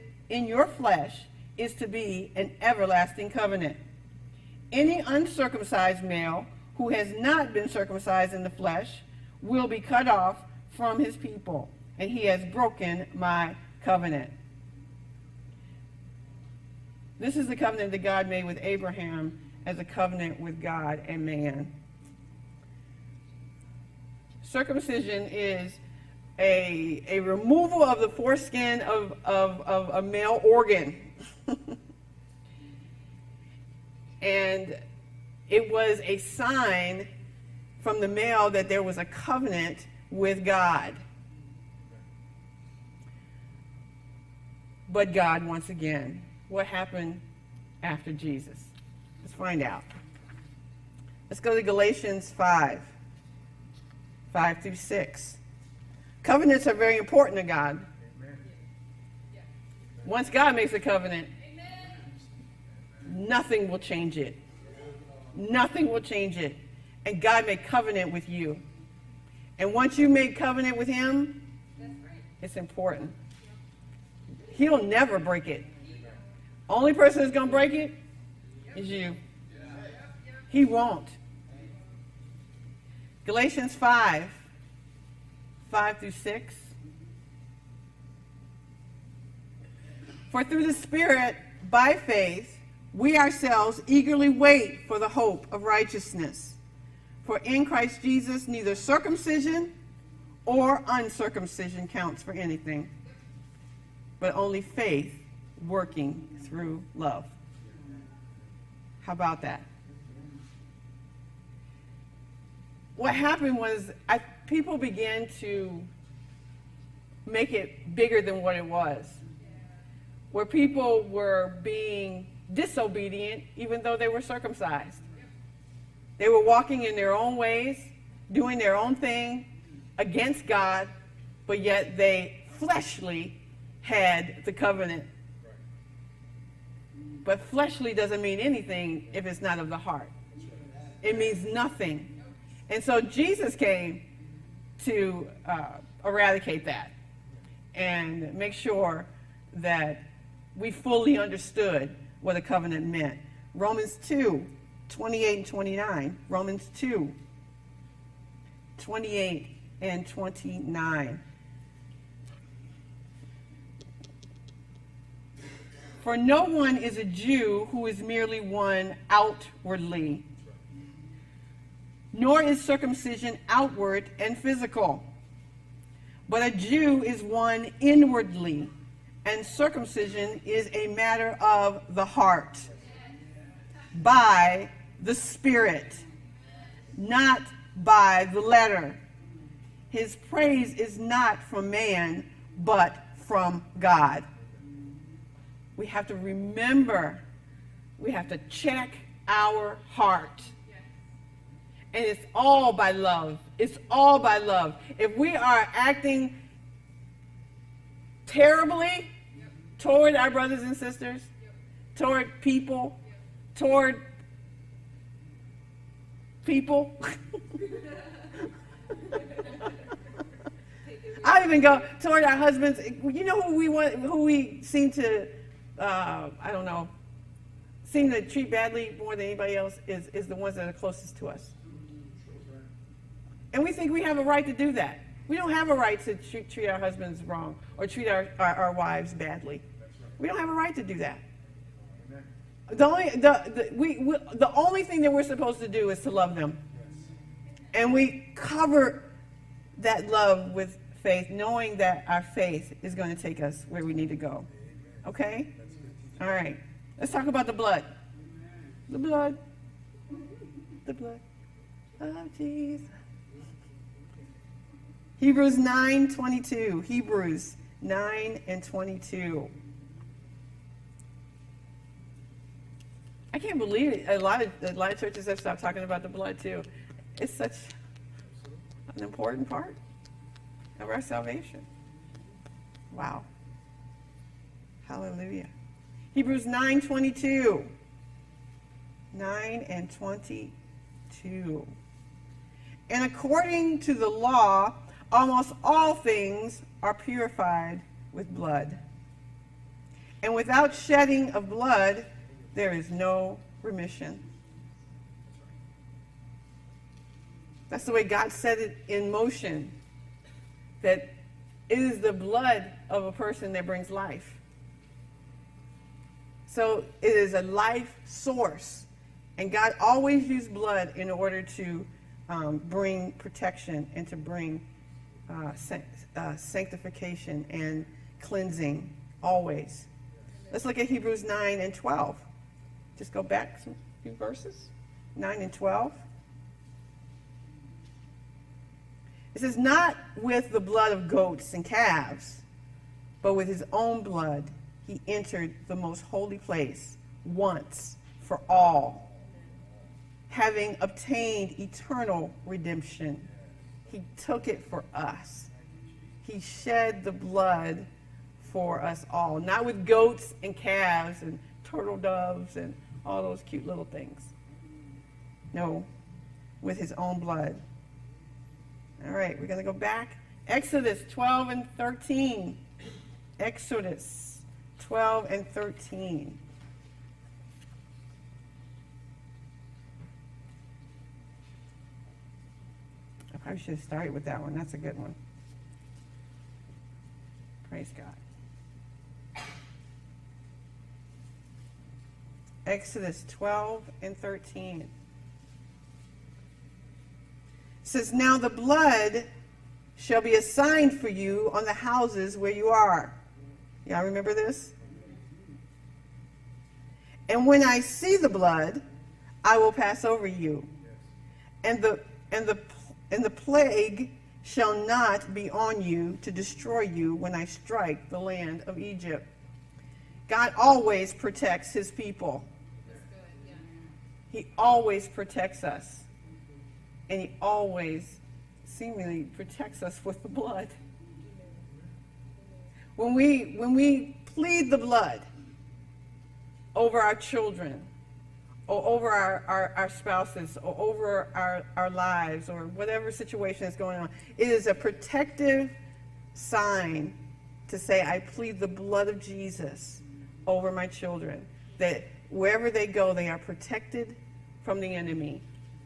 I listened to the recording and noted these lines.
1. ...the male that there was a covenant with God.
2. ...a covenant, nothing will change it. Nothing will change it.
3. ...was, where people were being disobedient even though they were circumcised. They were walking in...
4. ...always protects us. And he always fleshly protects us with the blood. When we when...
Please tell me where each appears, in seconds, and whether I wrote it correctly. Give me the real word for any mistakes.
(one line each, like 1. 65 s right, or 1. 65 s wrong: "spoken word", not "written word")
1. 38 s right
2. 60 s right
3. 118 s right
4. 424 s wrong: "seemingly", not "fleshly".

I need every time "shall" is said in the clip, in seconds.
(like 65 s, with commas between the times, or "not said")
399 s, 414 s.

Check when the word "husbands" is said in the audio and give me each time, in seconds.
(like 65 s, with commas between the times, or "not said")
222 s, 236 s.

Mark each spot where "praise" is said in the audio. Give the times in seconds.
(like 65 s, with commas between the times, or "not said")
190 s, 387 s.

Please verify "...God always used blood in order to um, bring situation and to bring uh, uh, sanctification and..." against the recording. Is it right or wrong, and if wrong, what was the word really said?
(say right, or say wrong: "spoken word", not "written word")
wrong: "protection", not "situation".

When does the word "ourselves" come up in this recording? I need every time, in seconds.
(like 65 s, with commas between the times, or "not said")
93 s.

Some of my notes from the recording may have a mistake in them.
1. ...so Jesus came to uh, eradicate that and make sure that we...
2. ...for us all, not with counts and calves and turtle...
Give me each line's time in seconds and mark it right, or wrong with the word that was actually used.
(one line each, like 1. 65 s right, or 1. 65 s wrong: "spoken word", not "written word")
1. 142 s right
2. 358 s wrong: "goats", not "counts".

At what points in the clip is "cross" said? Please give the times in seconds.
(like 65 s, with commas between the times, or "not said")
not said.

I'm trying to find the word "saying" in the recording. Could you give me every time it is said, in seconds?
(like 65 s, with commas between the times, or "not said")
not said.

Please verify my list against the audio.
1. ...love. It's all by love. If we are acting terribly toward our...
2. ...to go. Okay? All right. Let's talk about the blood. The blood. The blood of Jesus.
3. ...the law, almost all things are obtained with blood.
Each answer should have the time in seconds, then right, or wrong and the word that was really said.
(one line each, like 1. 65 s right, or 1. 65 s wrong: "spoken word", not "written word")
1. 202 s right
2. 254 s right
3. 293 s wrong: "purified", not "obtained".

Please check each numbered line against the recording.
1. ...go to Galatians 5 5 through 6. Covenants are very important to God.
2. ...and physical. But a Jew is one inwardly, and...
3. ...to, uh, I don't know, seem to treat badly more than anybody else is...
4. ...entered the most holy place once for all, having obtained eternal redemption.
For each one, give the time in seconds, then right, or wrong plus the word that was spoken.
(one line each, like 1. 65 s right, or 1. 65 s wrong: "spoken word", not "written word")
1. 51 s right
2. 174 s right
3. 224 s right
4. 345 s right.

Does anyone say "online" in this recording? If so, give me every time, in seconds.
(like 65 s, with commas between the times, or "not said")
not said.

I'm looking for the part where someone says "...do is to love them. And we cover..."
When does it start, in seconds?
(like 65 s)
245 s.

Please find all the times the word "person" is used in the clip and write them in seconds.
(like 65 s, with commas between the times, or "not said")
76 s, 313 s.